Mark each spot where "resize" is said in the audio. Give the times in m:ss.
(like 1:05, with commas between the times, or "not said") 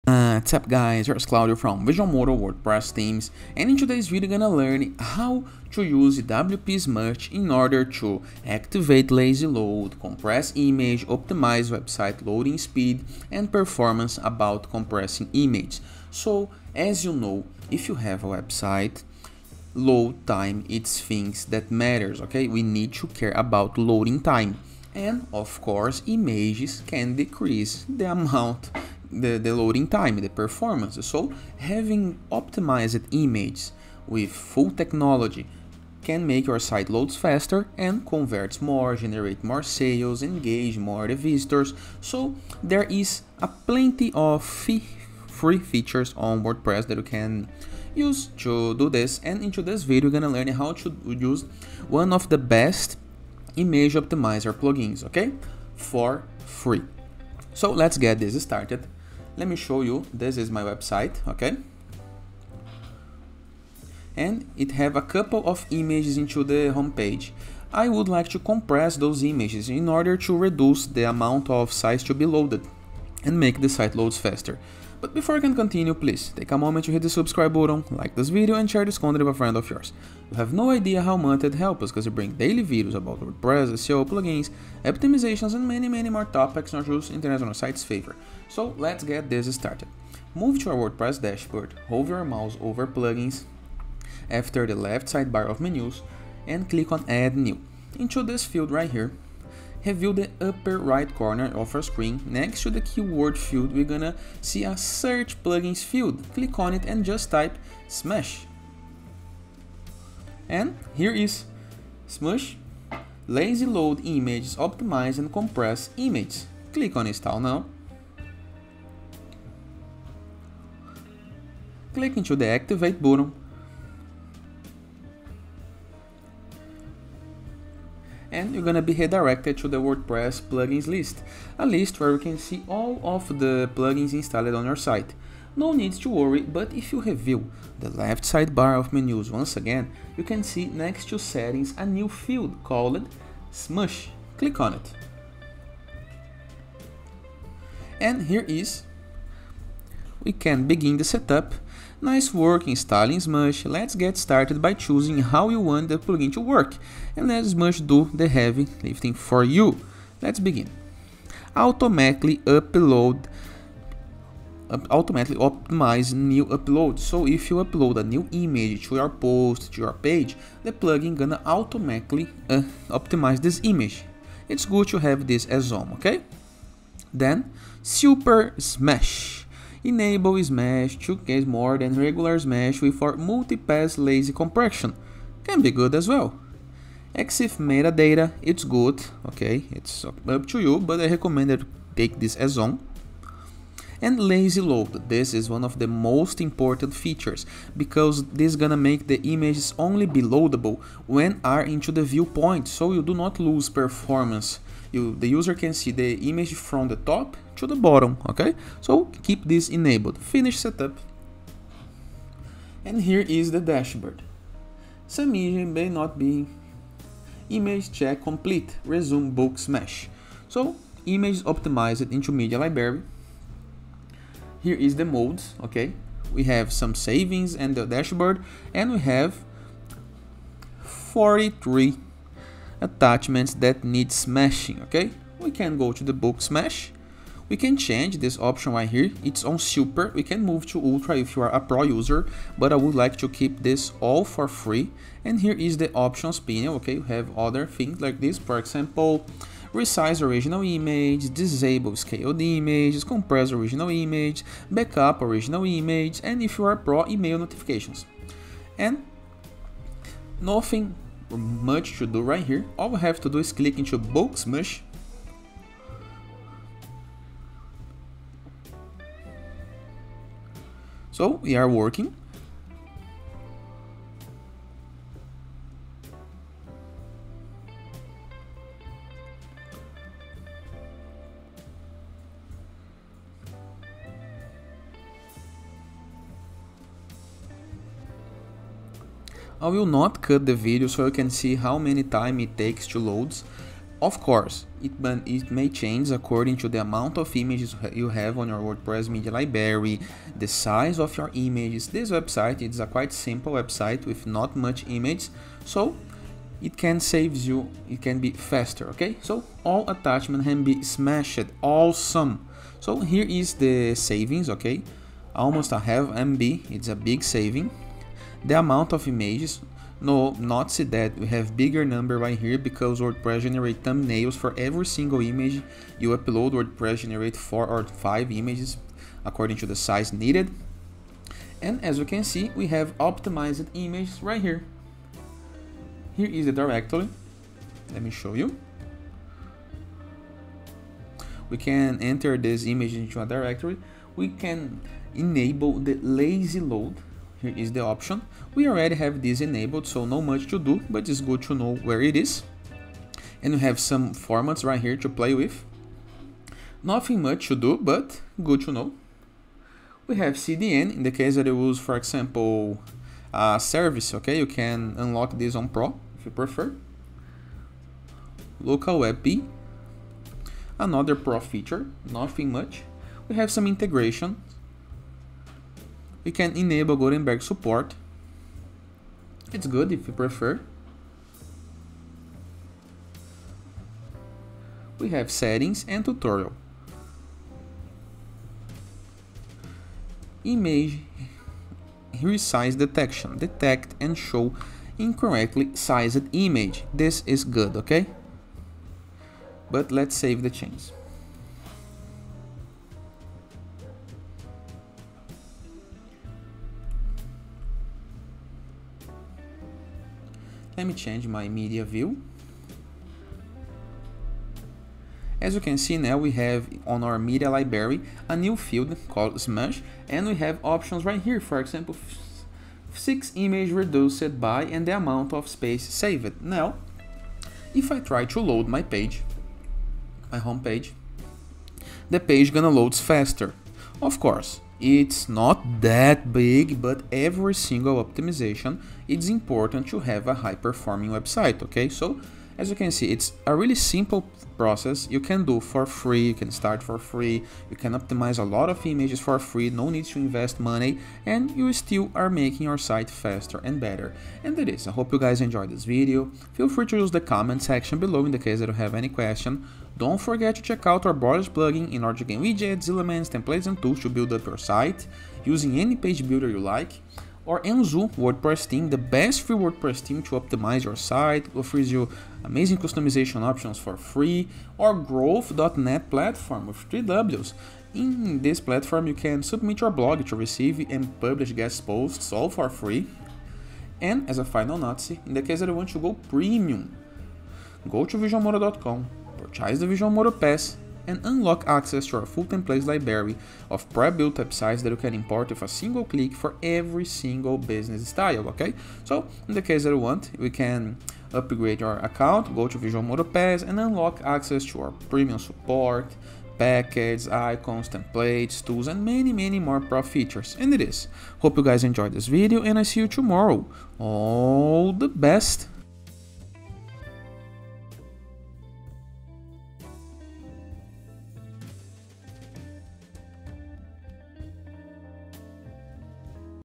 4:09, 6:32.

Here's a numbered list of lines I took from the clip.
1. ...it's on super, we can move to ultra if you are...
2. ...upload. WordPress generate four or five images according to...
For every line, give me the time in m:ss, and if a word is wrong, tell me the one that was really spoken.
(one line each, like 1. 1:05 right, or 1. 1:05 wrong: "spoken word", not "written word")
1. 3:59 right
2. 5:26 right.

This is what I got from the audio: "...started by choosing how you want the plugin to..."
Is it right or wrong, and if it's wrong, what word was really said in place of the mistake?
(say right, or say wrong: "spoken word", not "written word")
right.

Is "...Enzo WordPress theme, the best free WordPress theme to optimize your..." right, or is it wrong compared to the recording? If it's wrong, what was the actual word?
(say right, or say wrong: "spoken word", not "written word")
right.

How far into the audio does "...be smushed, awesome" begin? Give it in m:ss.
5:10.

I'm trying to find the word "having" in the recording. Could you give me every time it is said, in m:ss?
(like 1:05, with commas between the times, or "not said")
0:31.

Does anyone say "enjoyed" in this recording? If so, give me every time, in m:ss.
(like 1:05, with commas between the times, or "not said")
7:35, 8:31.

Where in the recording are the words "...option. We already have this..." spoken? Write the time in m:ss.
5:47.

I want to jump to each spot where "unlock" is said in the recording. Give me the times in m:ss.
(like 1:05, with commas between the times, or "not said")
6:04, 8:11, 8:23.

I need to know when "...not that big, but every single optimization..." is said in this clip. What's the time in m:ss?
7:15.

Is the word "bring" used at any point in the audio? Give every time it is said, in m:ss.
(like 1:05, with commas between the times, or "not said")
1:22.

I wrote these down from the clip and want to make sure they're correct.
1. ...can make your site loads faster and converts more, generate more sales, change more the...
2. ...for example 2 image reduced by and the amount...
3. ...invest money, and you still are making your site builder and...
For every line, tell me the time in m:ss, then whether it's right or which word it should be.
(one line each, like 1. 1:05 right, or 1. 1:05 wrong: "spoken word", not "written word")
1. 0:36 wrong: "engage", not "change"
2. 7:01 wrong: "6", not "2"
3. 7:30 wrong: "faster", not "builder".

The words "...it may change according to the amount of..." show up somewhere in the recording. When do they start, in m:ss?
4:55.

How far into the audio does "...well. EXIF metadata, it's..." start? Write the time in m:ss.
3:06.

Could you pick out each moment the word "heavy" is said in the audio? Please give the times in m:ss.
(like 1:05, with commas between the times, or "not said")
2:38.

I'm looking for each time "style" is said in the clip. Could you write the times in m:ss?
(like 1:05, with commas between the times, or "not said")
8:18.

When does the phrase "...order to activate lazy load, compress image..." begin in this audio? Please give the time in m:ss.
0:07.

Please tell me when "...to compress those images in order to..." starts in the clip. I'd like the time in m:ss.
1:08.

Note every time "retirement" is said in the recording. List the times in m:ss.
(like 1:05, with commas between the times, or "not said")
not said.